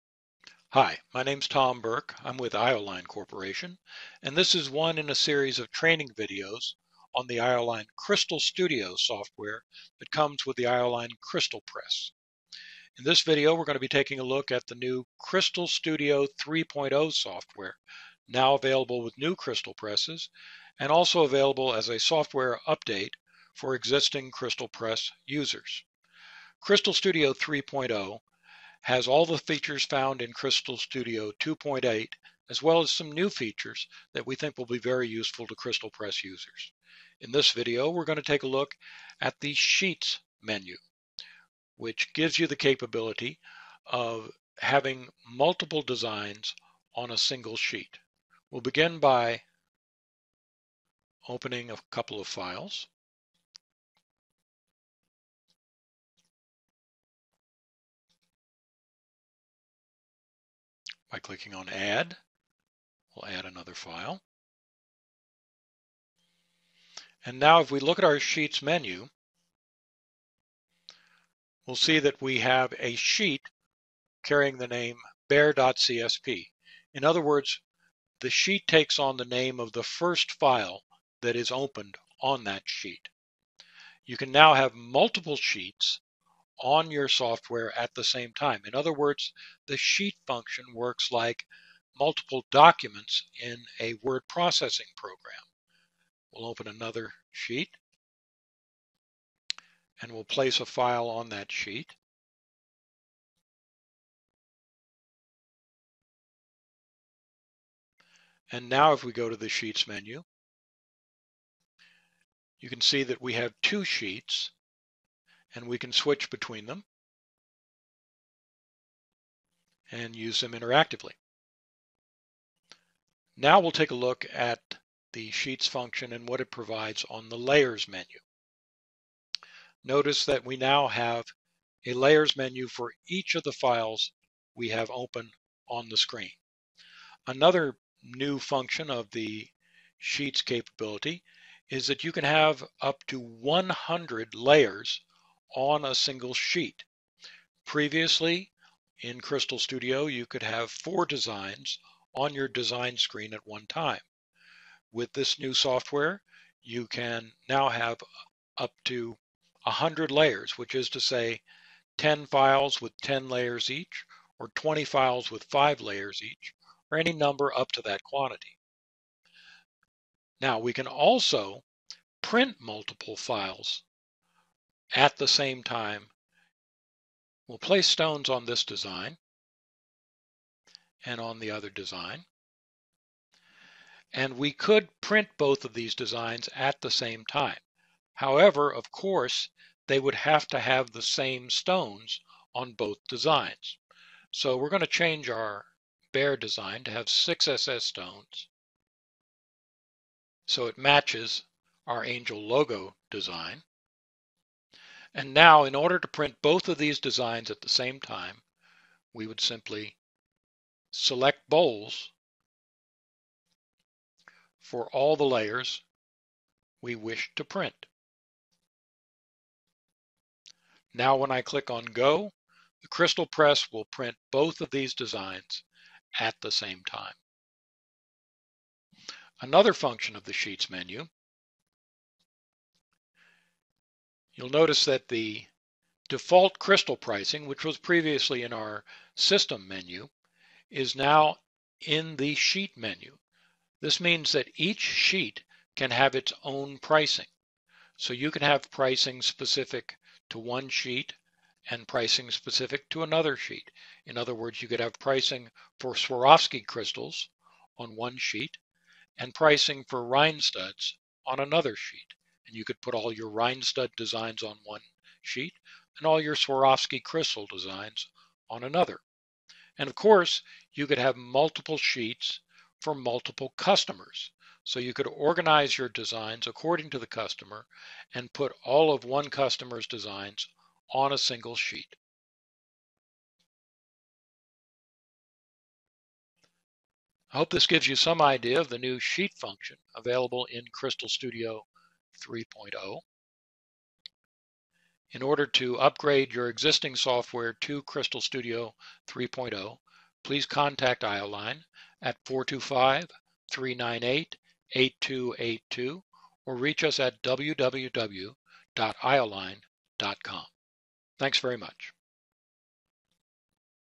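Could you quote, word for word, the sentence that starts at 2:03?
Now we'll take a look at the Sheets function and what it provides on the Layers menu.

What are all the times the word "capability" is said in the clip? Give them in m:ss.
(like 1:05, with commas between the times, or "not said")
0:42, 2:20.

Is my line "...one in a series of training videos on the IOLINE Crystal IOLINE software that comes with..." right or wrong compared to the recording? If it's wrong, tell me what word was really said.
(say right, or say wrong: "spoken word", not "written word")
wrong: "Studio", not "IOLINE".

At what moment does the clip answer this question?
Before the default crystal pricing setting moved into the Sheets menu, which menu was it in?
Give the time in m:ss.
3:59.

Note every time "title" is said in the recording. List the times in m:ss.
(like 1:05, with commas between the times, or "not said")
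not said.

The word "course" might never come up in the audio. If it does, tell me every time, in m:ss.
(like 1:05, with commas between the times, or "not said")
3:08, 4:29.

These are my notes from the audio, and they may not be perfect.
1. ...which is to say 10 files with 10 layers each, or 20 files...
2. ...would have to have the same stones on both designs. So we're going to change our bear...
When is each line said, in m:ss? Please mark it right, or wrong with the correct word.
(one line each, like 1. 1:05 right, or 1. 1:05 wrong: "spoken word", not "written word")
1. 2:40 right
2. 3:09 right.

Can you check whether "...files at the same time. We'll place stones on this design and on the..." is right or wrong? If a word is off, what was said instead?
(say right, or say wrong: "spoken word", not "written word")
right.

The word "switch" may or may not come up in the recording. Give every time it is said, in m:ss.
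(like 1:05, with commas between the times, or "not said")
1:55.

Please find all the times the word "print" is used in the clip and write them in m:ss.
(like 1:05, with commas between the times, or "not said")
2:52, 3:04, 3:26, 3:37, 3:43.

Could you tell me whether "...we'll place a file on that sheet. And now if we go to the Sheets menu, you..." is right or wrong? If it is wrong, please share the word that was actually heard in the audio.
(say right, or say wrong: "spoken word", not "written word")
right.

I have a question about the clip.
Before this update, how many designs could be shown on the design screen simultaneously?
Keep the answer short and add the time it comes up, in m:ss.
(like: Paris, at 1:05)
4, at 2:30.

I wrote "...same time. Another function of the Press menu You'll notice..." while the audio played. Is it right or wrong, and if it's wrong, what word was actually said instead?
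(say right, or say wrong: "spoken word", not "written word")
wrong: "Sheets", not "Press".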